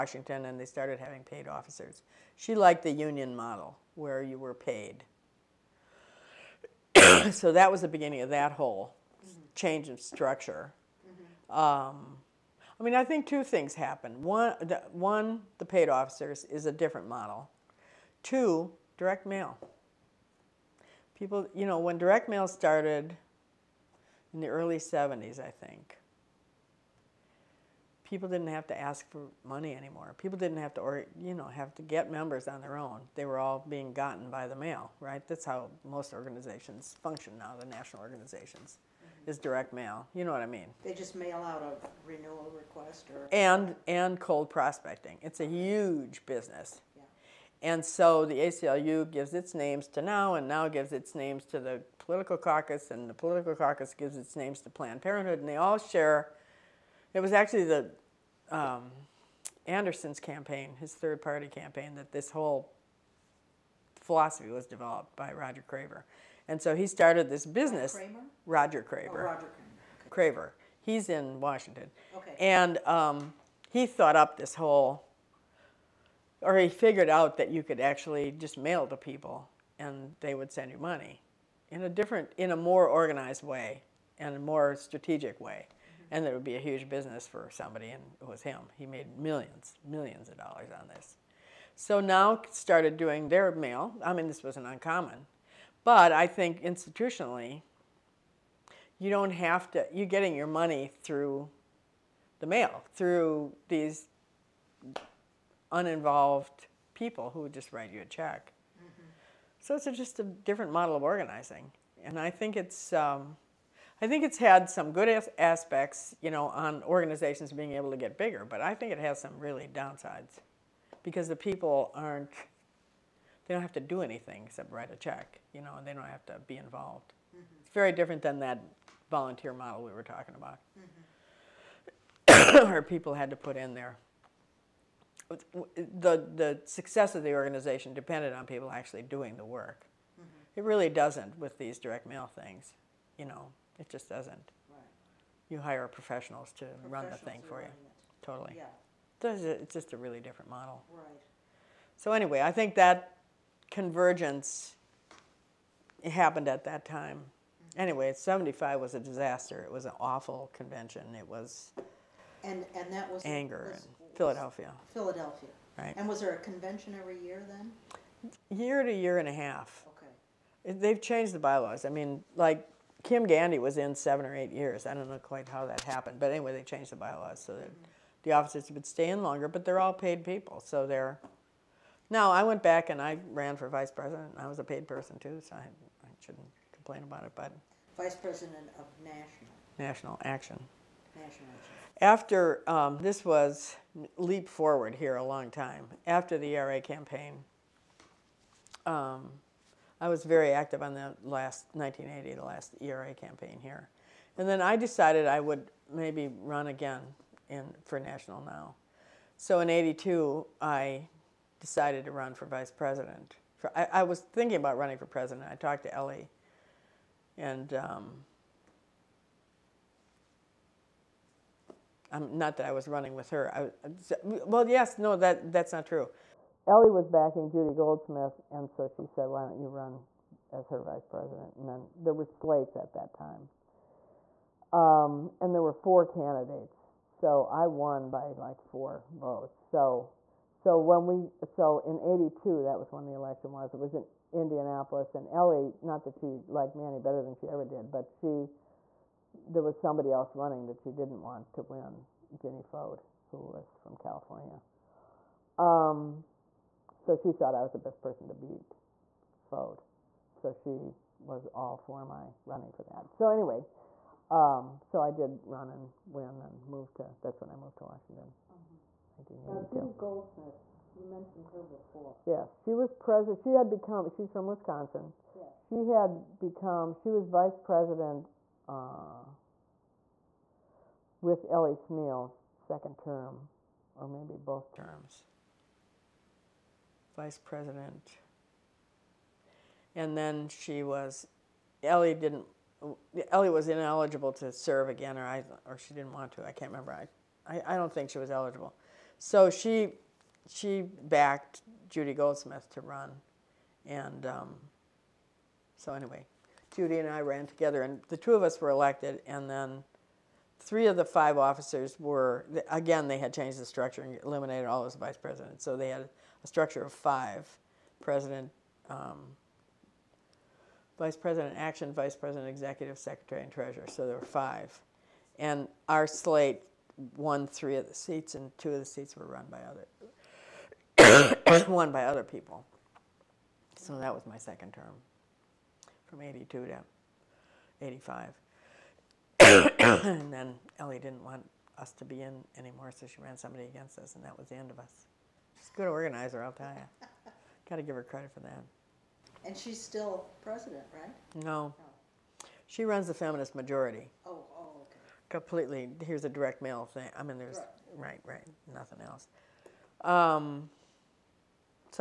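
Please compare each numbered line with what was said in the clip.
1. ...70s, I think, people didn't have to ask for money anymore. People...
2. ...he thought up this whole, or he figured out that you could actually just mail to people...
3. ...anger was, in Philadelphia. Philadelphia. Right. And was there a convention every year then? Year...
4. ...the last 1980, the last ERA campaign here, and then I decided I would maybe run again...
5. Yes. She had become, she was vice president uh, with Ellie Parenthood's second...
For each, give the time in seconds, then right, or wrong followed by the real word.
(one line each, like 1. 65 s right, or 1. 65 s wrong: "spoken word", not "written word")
1. 24 s right
2. 73 s right
3. 163 s right
4. 200 s right
5. 275 s wrong: "Smeal", not "Parenthood".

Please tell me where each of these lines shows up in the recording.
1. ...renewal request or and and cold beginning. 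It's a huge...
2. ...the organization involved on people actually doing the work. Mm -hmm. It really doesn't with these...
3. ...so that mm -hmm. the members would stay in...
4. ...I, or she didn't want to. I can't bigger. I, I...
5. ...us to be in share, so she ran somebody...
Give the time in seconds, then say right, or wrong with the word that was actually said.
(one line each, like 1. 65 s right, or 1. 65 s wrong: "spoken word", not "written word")
1. 42 s wrong: "prospecting", not "beginning"
2. 137 s wrong: "depended", not "involved"
3. 177 s wrong: "officers", not "members"
4. 295 s wrong: "remember", not "bigger"
5. 341 s wrong: "anymore", not "share".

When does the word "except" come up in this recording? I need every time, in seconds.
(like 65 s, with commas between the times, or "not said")
124 s.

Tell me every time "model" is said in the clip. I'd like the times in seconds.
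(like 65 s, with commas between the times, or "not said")
3 s, 17 s, 110 s, 129 s, 150 s.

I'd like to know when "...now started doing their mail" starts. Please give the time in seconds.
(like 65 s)
92 s.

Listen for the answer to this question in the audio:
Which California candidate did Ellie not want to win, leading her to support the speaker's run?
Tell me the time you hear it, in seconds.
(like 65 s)
252 s.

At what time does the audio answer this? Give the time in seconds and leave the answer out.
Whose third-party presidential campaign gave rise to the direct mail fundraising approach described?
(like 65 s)
59 s.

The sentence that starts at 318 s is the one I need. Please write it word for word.
Um, Vice President Action, Vice President Executive Secretary, and Treasurer.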